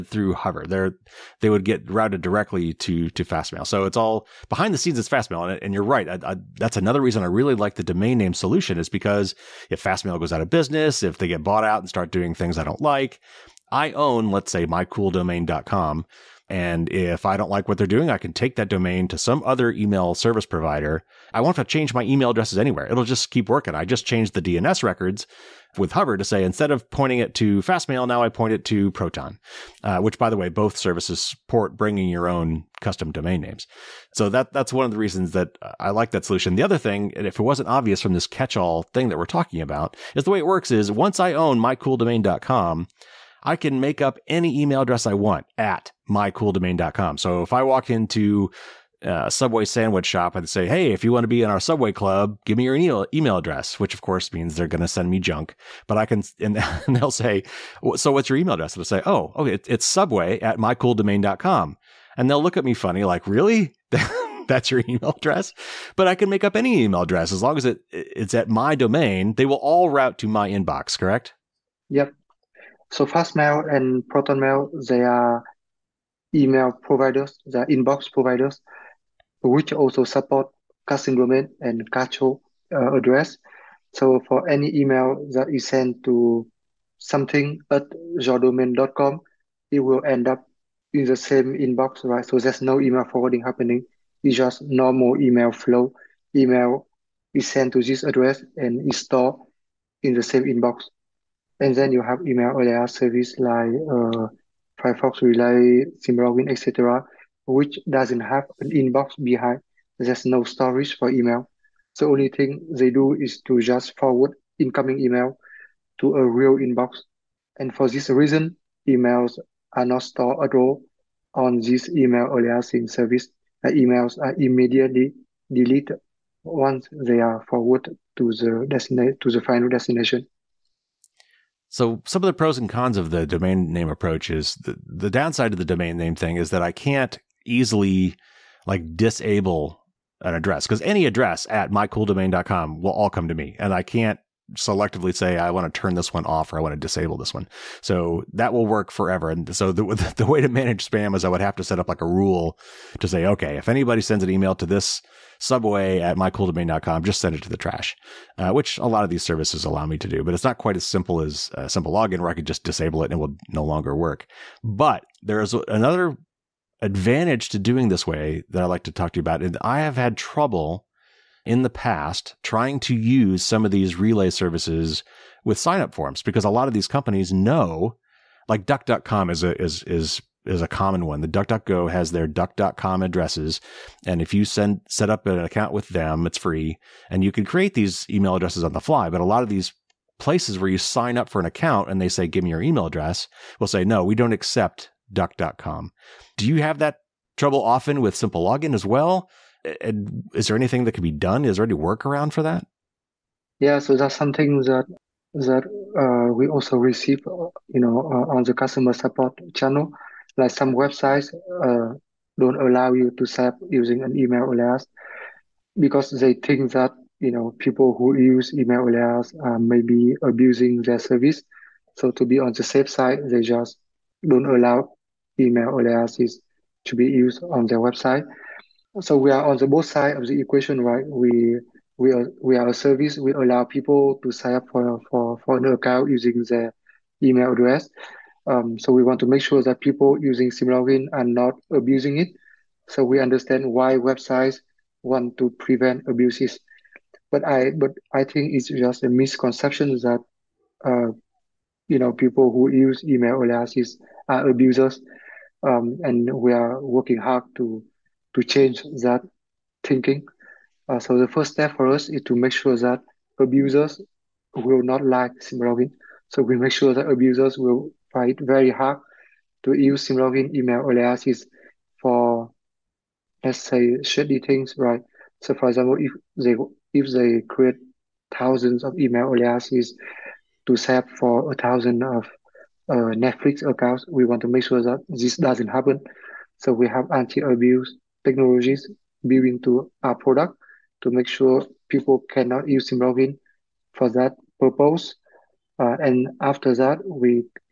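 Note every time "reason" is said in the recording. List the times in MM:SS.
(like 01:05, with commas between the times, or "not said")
00:06, 00:34, 01:58.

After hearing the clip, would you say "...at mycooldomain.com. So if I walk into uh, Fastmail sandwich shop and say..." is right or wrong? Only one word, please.
wrong.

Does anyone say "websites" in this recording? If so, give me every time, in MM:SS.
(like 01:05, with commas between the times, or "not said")
03:30, 03:47, 04:03.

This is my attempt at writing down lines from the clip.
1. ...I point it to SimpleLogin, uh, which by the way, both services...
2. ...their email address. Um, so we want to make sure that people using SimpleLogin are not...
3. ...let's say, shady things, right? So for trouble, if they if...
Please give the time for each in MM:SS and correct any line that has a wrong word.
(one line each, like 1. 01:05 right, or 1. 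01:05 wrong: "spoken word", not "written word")
1. 00:28 wrong: "Proton", not "SimpleLogin"
2. 03:56 right
3. 04:33 wrong: "example", not "trouble".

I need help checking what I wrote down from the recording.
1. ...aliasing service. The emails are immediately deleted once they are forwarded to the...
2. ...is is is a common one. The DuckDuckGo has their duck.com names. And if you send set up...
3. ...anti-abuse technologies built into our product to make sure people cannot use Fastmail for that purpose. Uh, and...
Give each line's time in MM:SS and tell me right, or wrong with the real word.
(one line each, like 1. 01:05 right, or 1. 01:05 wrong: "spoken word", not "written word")
1. 02:02 right
2. 02:59 wrong: "addresses", not "names"
3. 04:47 wrong: "SimpleLogin", not "Fastmail".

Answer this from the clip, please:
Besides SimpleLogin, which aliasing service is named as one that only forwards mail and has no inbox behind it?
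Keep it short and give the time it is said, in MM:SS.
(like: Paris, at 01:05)
Firefox Relay, at 01:44.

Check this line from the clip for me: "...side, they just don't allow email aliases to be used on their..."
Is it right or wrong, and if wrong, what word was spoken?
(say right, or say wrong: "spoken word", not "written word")
right.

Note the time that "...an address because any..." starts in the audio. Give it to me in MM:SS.
02:20.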